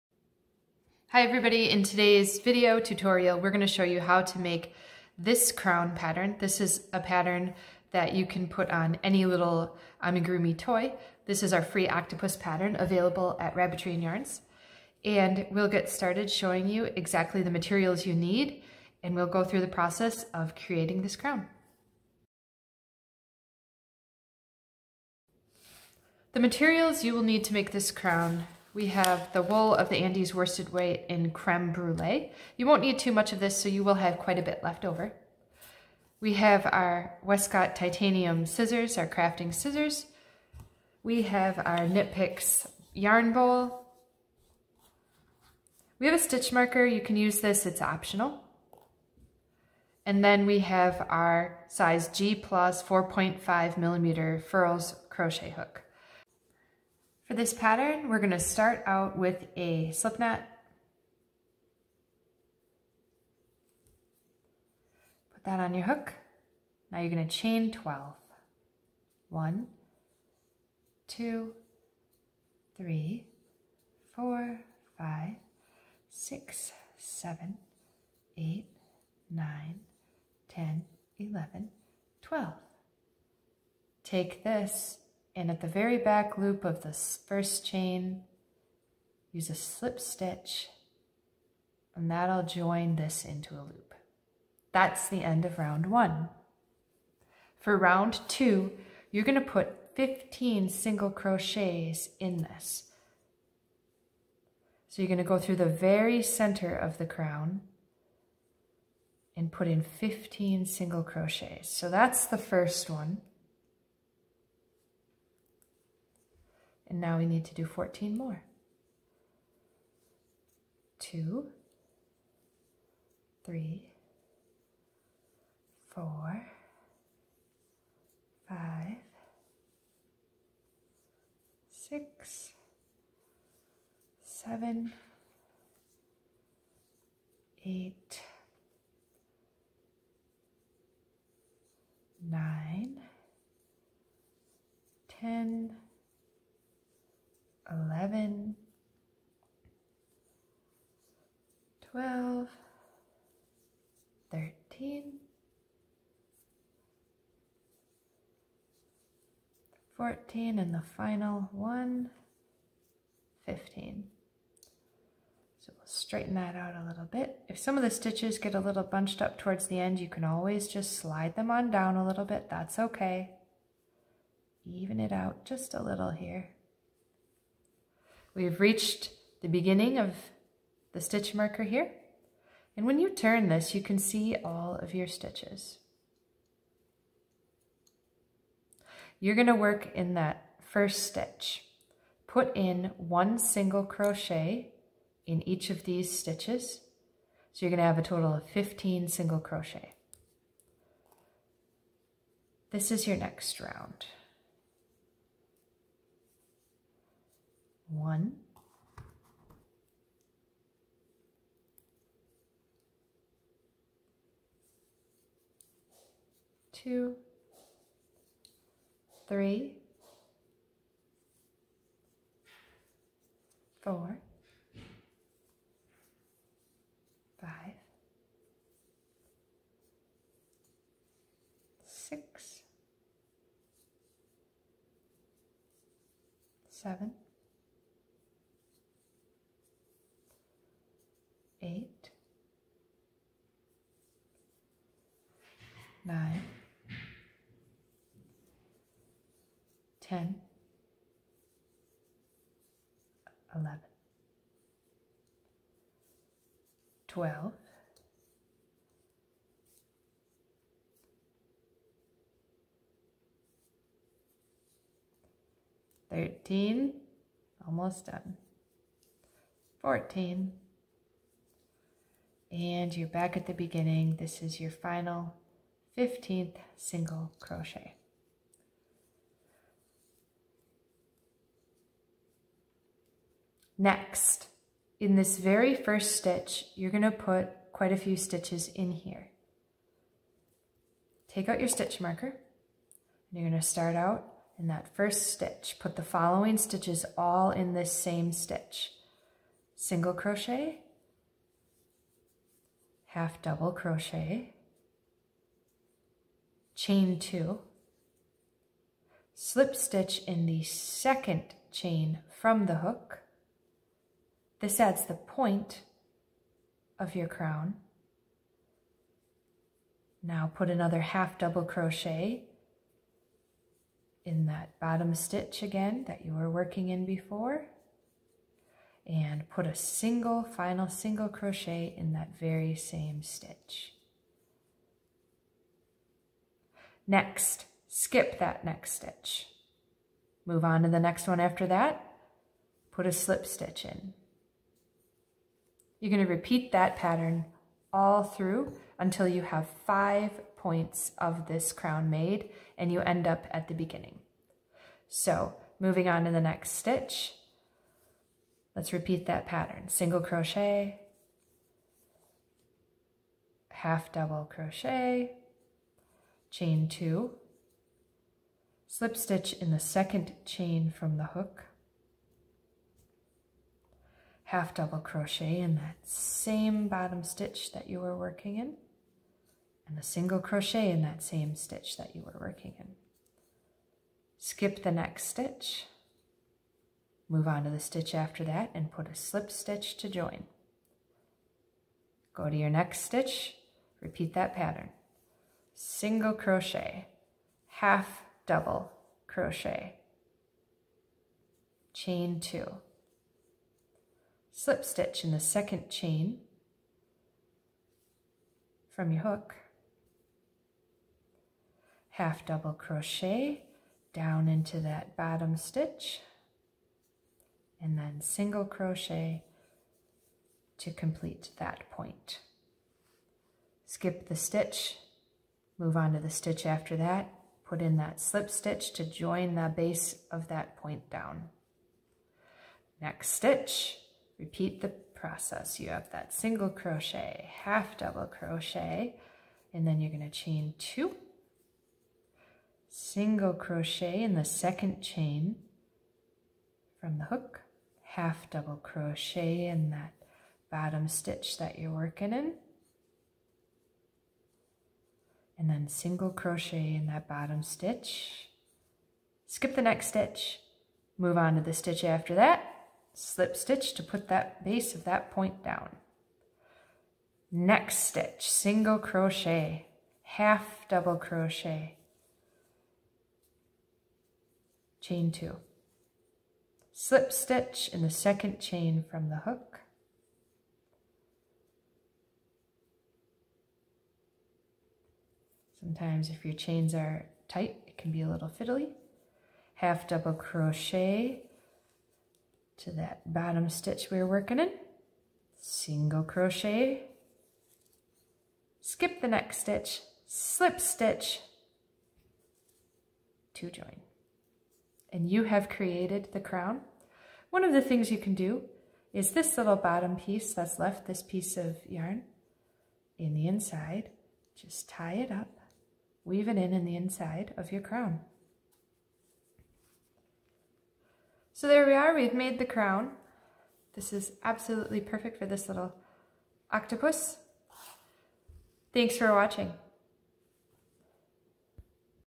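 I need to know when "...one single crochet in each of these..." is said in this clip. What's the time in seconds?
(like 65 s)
192 s.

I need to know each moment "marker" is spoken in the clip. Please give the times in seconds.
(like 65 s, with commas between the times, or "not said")
46 s, 181 s, 292 s.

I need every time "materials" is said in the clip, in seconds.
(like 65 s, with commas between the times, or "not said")
17 s, 26 s.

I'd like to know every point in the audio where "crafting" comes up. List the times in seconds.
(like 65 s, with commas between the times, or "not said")
39 s.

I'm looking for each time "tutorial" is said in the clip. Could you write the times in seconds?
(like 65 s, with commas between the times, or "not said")
2 s.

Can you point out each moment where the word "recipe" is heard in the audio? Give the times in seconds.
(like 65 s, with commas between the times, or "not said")
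not said.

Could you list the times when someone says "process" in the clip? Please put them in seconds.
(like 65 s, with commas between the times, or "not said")
19 s, 434 s.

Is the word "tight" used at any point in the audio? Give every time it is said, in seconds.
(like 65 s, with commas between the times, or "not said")
487 s.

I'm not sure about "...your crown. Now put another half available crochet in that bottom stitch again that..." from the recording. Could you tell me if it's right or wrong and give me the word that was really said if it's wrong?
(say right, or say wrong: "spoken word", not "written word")
wrong: "double", not "available".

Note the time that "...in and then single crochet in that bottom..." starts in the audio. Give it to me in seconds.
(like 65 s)
452 s.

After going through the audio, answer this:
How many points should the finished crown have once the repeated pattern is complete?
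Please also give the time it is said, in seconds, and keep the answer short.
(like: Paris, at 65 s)
5, at 349 s.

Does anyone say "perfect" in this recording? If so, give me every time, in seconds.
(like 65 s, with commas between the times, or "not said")
525 s.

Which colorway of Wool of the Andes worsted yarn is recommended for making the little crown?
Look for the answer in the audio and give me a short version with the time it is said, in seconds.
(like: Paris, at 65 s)
Creme brulee, at 31 s.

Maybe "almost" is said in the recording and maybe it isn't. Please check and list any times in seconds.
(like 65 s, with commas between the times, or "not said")
267 s.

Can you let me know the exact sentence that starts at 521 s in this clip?
So there we are, we've made the crown.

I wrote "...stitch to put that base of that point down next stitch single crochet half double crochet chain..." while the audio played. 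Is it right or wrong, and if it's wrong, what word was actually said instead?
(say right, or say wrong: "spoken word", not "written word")
right.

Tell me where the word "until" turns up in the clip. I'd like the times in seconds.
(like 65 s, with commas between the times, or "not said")
348 s.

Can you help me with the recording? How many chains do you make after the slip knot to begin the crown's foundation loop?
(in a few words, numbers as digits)
12.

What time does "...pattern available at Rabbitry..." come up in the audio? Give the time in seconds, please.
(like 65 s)
12 s.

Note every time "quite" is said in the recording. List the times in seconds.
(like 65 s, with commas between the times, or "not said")
34 s, 287 s.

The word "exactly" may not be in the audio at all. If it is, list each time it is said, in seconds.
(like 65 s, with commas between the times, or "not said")
16 s.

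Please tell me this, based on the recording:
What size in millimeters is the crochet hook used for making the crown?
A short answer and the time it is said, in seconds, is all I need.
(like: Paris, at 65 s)
4.5 millimeters, at 52 s.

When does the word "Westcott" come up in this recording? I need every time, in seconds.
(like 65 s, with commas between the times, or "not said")
37 s.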